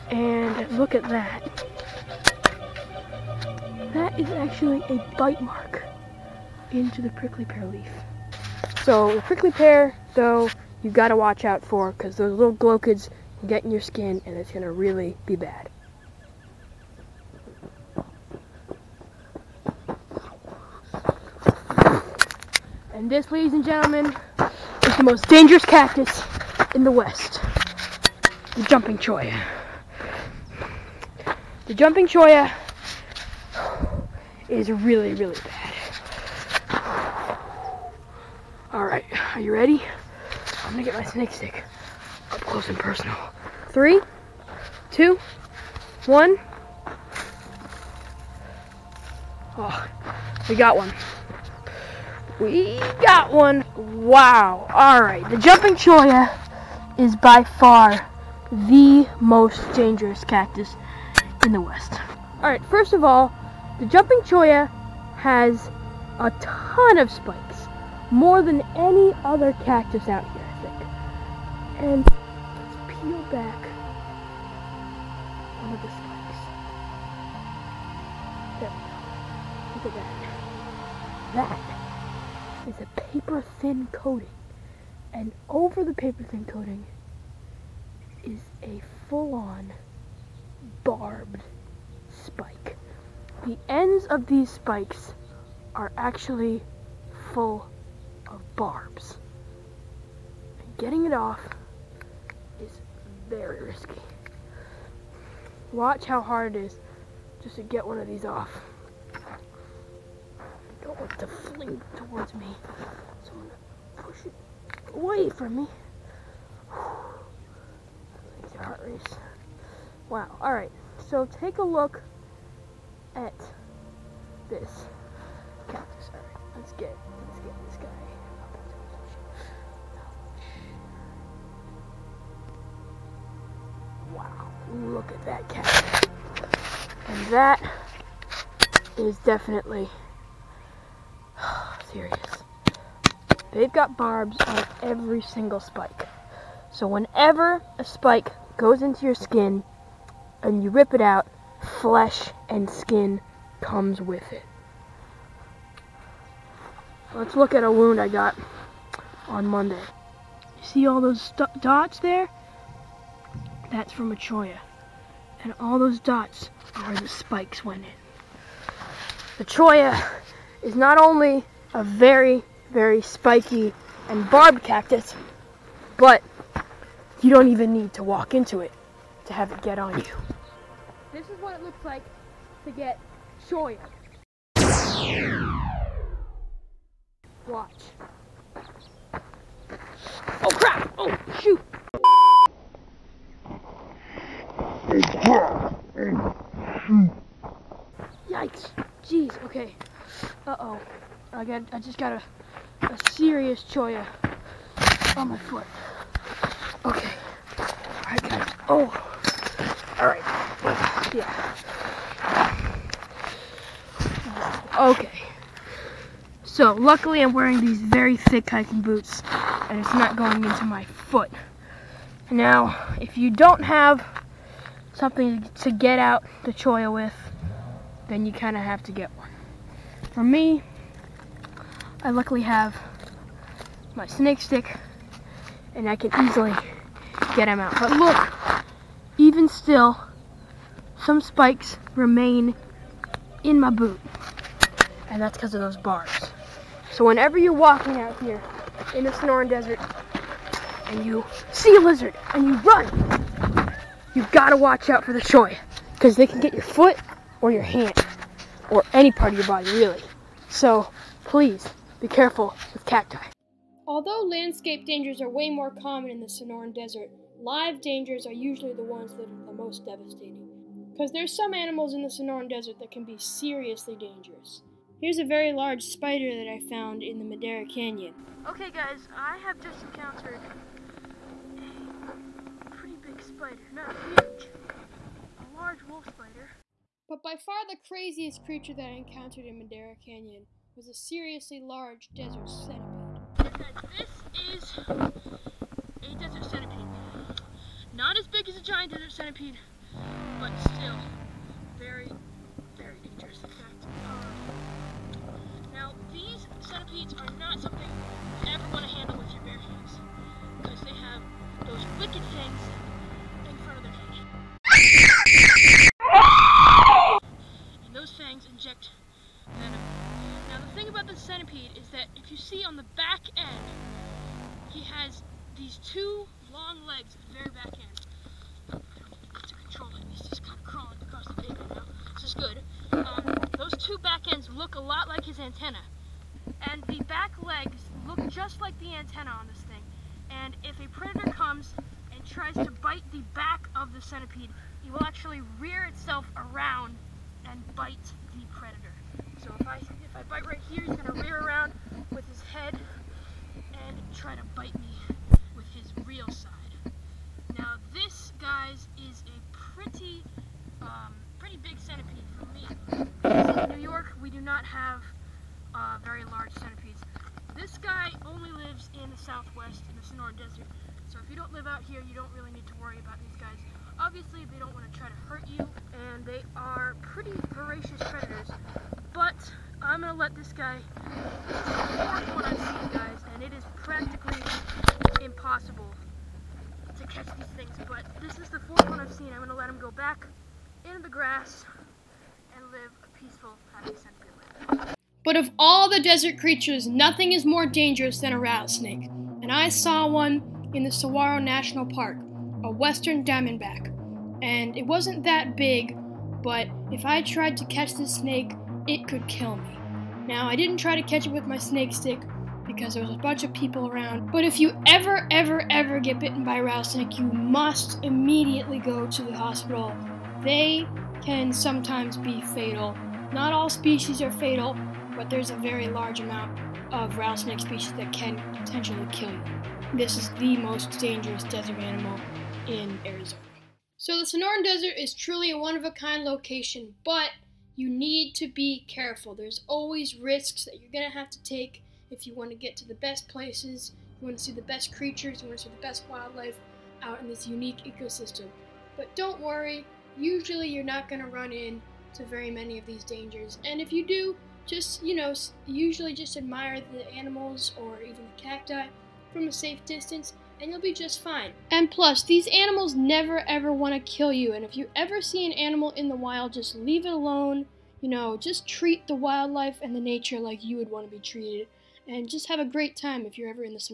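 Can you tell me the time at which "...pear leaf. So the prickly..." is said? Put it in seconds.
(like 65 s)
7 s.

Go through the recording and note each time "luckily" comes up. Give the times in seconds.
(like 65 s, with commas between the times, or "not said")
216 s, 232 s.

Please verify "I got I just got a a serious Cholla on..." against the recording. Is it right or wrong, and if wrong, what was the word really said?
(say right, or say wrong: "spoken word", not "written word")
right.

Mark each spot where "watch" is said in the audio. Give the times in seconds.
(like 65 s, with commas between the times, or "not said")
11 s, 105 s, 187 s, 254 s.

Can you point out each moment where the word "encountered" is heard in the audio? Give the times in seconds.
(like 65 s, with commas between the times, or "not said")
279 s, 288 s.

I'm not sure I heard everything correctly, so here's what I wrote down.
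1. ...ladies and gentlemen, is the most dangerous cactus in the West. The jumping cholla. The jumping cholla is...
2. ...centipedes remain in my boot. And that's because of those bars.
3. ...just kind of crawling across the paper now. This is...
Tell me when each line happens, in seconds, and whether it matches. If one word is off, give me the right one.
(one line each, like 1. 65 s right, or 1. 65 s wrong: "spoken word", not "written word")
1. 23 s right
2. 241 s wrong: "spikes", not "centipedes"
3. 330 s right.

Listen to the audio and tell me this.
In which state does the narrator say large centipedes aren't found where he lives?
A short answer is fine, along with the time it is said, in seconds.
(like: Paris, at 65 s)
New York, at 363 s.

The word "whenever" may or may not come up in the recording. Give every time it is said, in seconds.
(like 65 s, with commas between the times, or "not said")
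146 s, 247 s.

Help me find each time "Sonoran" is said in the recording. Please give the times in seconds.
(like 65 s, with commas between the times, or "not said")
249 s, 266 s, 272 s, 370 s, 434 s.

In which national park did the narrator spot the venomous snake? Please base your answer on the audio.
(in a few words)
Saguaro National Park.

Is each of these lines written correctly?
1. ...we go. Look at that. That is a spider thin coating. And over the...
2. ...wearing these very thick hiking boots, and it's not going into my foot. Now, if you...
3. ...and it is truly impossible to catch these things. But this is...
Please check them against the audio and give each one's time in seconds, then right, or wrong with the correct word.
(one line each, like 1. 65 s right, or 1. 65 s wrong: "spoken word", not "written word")
1. 78 s wrong: "paper", not "spider"
2. 217 s right
3. 383 s wrong: "practically", not "truly".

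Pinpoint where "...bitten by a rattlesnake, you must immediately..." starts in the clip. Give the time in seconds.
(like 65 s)
416 s.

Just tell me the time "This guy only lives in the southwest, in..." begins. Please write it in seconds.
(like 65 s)
367 s.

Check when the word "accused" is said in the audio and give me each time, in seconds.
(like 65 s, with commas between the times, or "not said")
not said.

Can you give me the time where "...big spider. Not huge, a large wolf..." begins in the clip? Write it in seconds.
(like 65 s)
283 s.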